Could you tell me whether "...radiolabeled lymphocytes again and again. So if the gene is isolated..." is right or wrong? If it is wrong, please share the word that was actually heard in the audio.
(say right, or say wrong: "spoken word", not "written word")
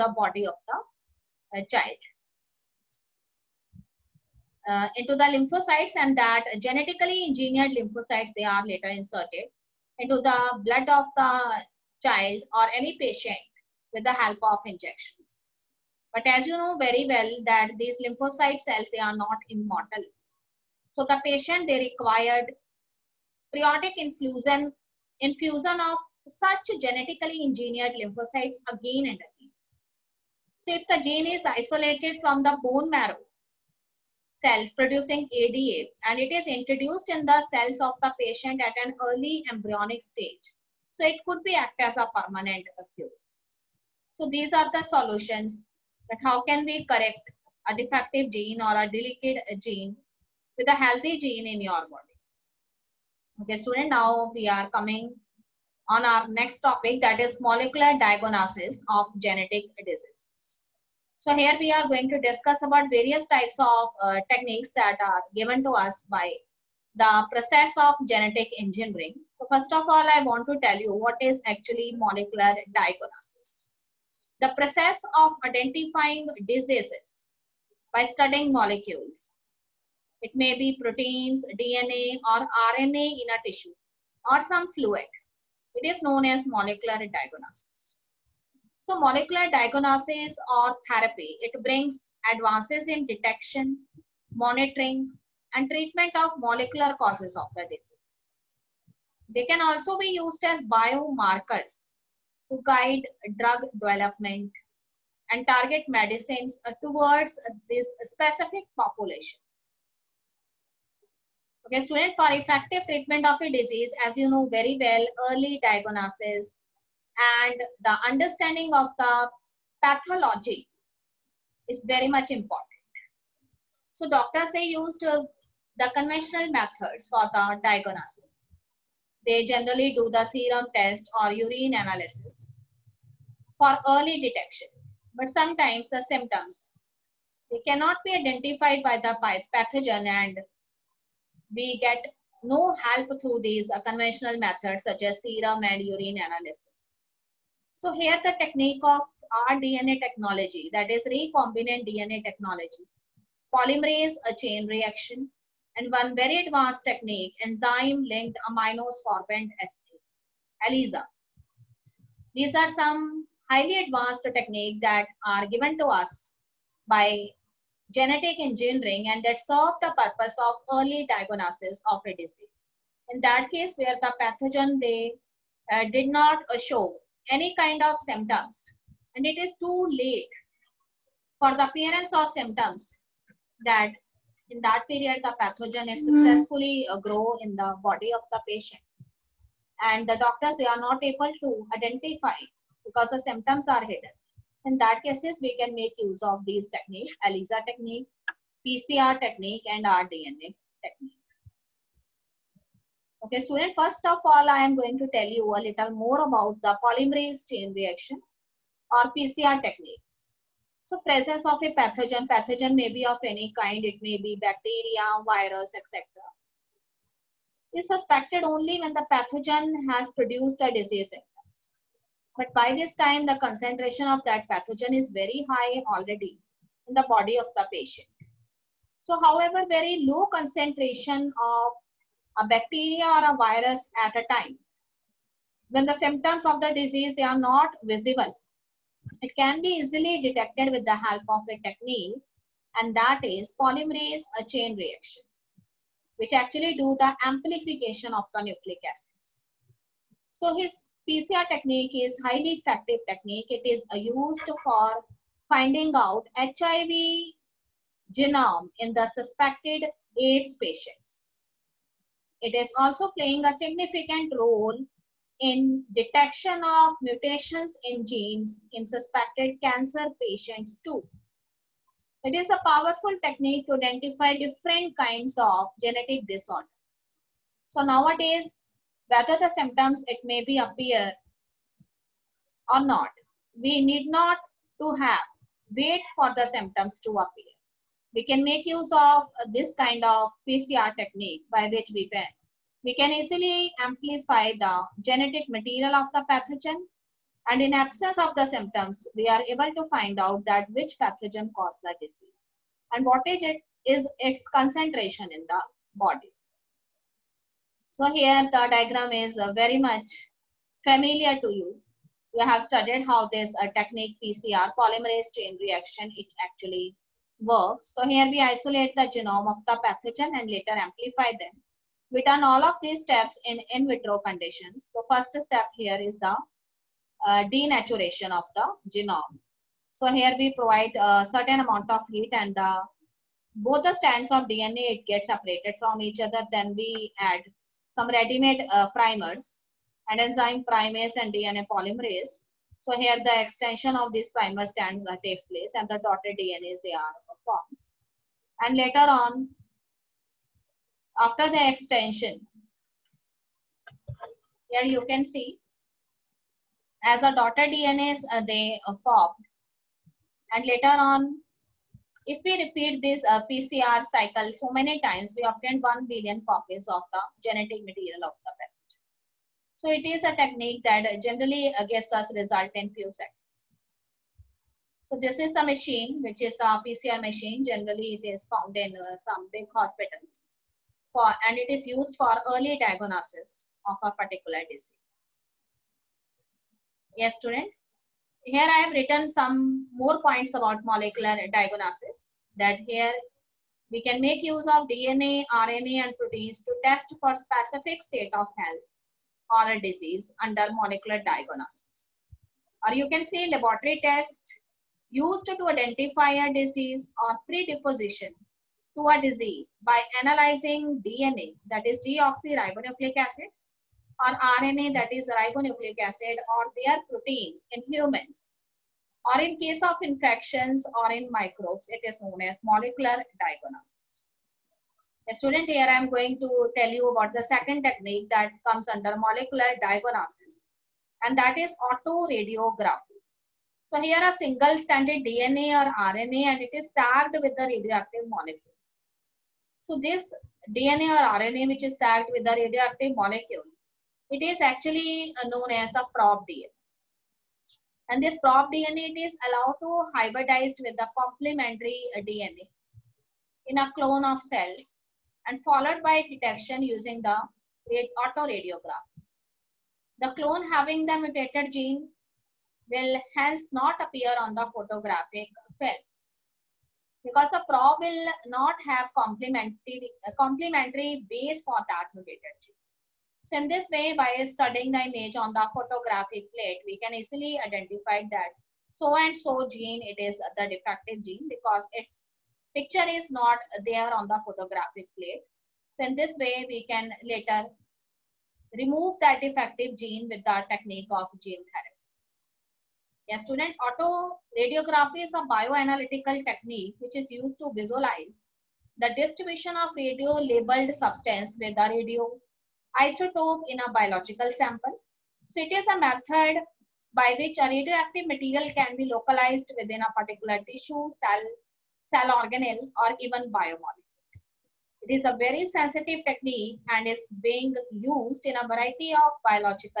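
wrong: "engineered", not "radiolabeled".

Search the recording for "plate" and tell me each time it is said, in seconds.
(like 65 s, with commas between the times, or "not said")
476 s, 485 s.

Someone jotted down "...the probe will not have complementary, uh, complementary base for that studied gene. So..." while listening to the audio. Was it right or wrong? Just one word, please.
wrong.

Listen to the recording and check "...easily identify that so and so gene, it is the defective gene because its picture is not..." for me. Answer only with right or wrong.
right.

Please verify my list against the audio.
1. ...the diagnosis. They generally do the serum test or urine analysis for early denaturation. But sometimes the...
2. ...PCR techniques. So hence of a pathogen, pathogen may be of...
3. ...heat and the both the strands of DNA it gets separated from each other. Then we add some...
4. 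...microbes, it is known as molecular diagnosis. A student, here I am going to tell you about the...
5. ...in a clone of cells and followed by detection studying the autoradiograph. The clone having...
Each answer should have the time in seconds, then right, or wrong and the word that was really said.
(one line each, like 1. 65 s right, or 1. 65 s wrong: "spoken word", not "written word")
1. 127 s wrong: "detection", not "denaturation"
2. 209 s wrong: "presence", not "hence"
3. 332 s right
4. 421 s right
5. 453 s wrong: "using", not "studying".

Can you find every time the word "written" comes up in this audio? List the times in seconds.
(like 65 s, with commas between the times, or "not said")
388 s.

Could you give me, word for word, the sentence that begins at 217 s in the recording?
Is suspected only when the pathogen has produced a disease symptoms.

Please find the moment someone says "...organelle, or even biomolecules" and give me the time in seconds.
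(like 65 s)
512 s.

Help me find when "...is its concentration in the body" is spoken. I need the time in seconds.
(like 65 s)
303 s.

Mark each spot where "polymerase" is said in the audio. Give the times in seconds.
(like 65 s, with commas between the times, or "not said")
153 s, 206 s, 243 s, 314 s, 341 s.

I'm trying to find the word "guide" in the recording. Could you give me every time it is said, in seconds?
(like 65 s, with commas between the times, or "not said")
102 s.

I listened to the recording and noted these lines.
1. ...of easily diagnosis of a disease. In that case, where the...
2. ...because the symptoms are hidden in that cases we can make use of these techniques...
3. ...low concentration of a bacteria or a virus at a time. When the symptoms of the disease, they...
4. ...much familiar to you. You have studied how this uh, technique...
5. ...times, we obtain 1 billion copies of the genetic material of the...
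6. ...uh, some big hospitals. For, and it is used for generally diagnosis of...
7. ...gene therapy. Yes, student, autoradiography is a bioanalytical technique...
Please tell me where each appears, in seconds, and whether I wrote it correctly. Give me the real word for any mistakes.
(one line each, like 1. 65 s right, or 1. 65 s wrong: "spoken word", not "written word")
1. 170 s wrong: "early", not "easily"
2. 192 s right
3. 230 s right
4. 309 s right
5. 365 s right
6. 378 s wrong: "early", not "generally"
7. 491 s right.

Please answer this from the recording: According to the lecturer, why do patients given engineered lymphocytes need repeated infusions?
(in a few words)
They are not immortal.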